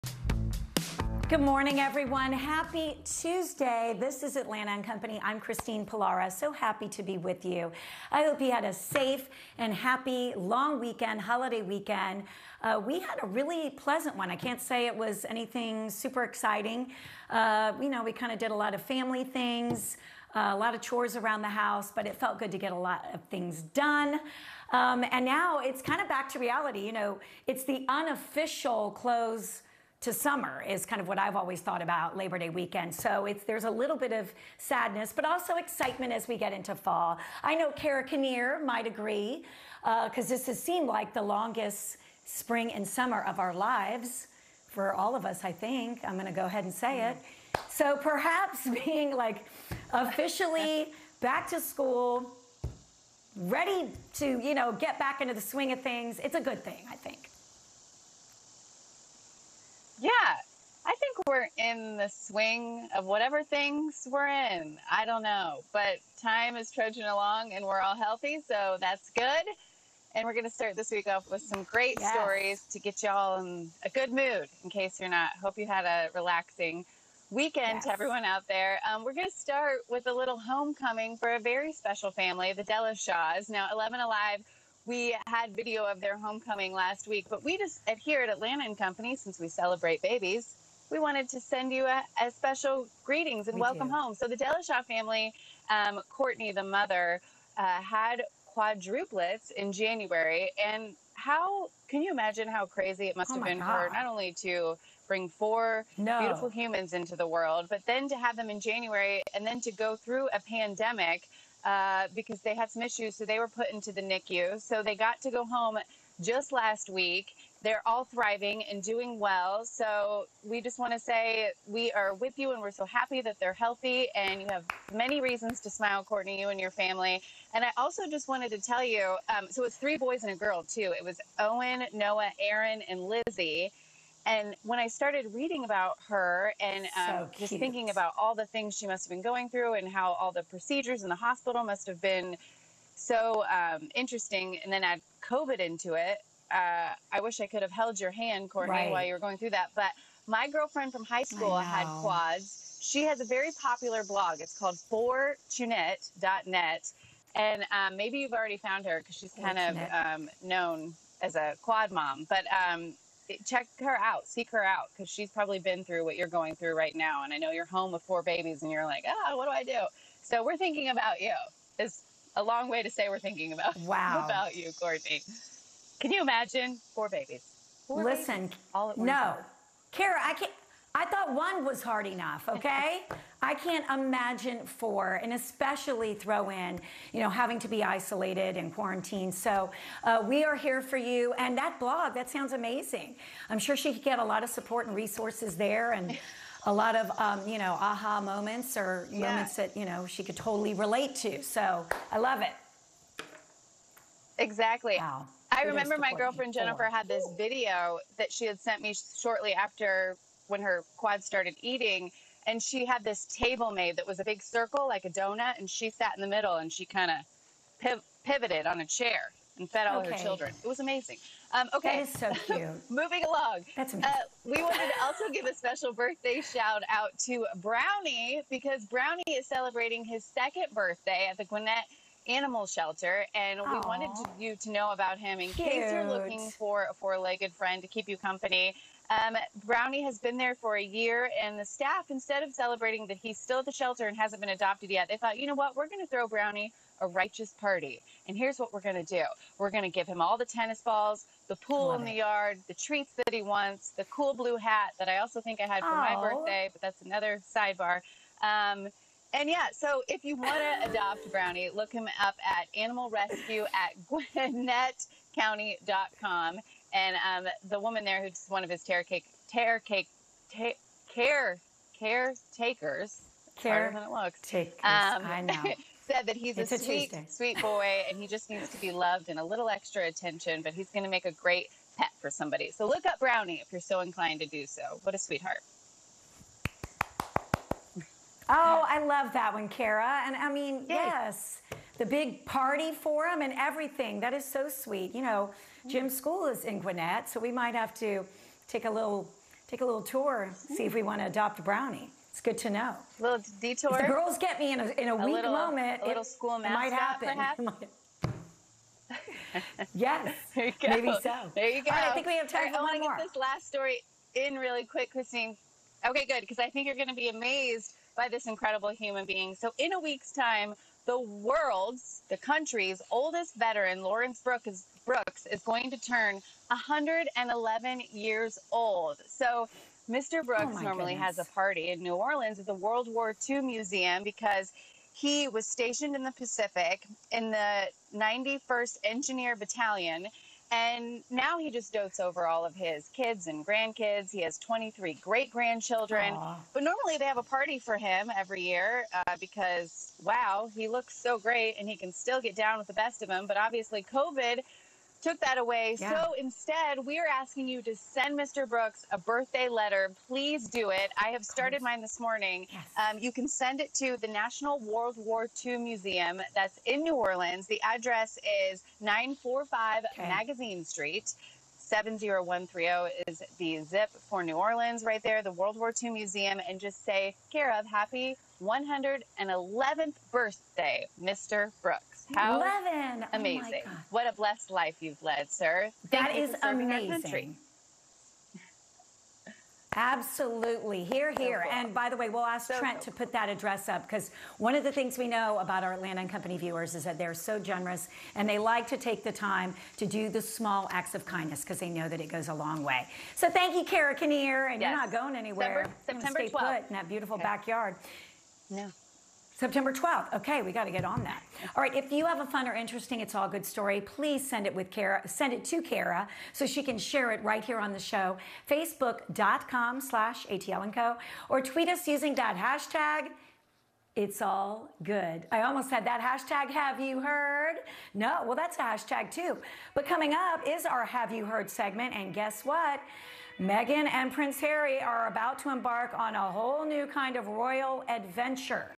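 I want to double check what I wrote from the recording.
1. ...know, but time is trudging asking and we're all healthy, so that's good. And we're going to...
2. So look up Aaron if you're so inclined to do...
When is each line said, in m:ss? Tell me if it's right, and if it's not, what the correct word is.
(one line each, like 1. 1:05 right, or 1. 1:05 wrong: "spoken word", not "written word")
1. 1:05 wrong: "along", not "asking"
2. 4:42 wrong: "Brownie", not "Aaron".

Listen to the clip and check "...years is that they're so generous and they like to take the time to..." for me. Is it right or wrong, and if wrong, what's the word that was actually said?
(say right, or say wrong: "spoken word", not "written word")
wrong: "viewers", not "years".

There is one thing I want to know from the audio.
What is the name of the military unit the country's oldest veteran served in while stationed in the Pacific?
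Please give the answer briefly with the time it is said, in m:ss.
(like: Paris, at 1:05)
91st Engineer Battalion, at 5:38.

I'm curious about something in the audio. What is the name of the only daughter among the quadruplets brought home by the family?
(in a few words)
Lizzie.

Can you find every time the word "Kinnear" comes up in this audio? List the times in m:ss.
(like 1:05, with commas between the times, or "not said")
0:38, 6:44.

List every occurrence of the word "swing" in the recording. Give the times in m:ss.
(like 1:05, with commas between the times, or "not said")
0:55, 1:02.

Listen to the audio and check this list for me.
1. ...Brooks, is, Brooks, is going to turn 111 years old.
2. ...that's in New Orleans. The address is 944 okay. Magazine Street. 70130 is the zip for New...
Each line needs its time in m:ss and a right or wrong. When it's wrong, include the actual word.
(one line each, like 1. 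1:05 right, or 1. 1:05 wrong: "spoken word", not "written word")
1. 5:24 right
2. 6:06 wrong: "945", not "944".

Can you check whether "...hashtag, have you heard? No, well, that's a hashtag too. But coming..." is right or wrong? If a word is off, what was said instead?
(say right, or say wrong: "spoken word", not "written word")
right.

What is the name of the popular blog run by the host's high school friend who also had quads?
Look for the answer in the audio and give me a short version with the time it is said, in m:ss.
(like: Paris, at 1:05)
fortunette.net, at 2:34.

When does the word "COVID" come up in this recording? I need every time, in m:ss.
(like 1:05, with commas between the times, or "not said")
2:25, 5:54.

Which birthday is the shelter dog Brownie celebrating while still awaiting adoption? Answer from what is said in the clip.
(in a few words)
second.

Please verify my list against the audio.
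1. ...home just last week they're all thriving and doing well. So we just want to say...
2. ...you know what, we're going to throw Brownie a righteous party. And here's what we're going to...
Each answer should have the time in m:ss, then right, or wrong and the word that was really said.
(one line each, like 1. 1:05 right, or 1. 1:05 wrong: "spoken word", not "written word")
1. 1:55 right
2. 4:05 right.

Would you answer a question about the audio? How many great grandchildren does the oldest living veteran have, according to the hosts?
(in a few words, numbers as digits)
23.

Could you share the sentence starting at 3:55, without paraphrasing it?
case you're looking for a four-legged friend to keep you company.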